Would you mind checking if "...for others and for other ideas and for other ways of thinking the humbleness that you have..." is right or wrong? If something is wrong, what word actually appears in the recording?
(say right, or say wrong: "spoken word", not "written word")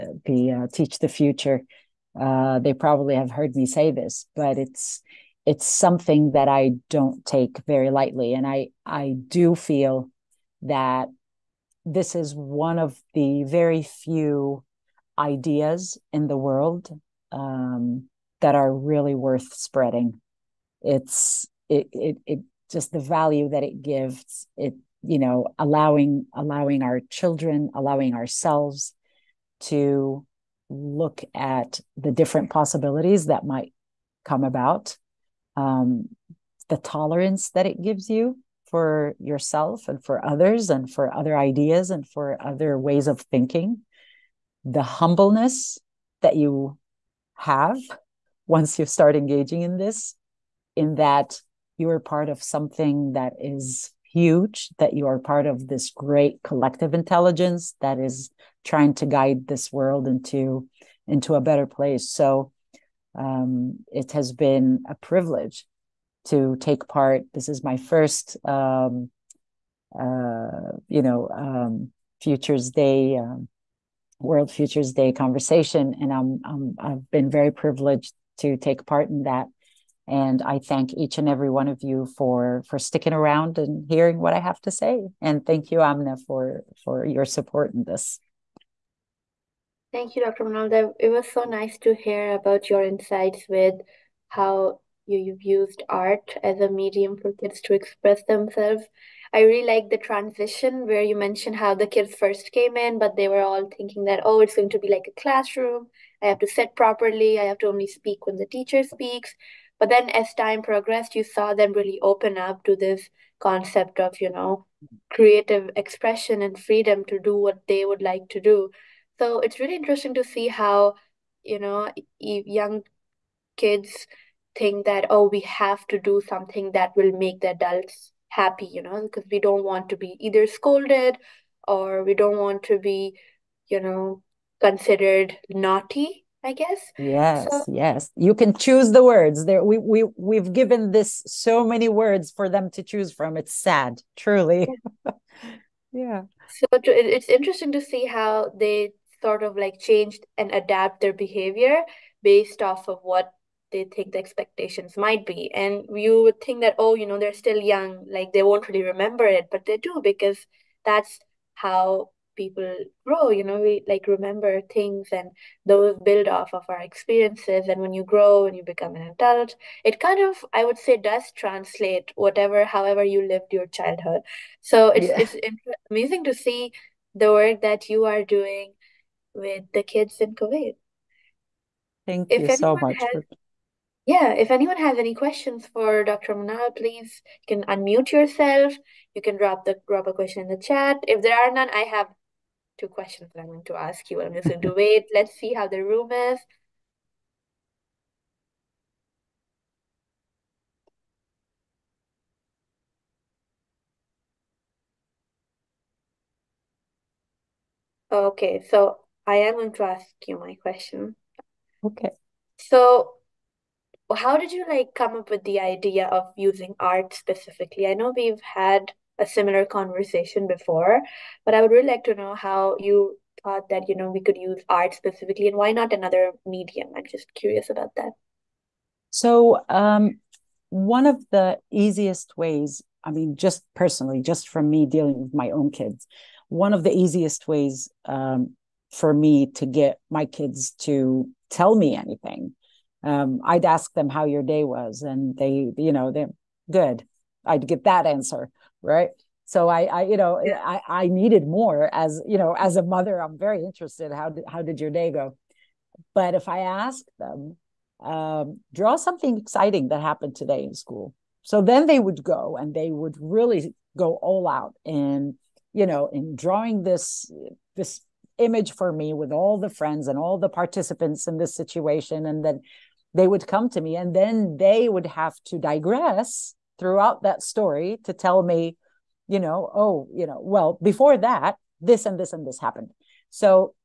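right.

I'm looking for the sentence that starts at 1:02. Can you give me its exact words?
So um, it has been a privilege to take part.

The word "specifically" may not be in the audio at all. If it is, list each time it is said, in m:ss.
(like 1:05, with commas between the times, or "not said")
3:37, 3:44.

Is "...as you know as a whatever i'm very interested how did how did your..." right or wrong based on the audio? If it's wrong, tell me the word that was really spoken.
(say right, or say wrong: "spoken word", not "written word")
wrong: "mother", not "whatever".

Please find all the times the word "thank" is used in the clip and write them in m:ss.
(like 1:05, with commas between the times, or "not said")
1:20, 1:25, 1:29, 3:02.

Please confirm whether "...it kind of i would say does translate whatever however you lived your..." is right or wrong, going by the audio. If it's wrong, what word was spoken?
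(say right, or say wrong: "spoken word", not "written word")
right.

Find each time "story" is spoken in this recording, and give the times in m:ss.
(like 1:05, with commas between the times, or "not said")
4:37.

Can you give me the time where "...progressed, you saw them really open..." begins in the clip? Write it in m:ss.
1:50.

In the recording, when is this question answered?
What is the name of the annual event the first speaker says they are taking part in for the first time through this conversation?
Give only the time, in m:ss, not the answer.
1:14.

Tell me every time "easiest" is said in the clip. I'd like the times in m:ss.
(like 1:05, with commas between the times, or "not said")
3:51, 3:56.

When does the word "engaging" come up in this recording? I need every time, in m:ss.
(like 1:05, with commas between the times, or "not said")
0:49.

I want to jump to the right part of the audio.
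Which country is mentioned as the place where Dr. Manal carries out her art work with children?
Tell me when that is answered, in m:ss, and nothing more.
3:00.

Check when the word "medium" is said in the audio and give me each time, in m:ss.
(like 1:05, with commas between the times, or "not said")
1:36, 3:46.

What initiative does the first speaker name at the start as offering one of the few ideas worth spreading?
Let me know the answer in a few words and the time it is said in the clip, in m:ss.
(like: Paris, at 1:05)
Teach the Future, at 0:00.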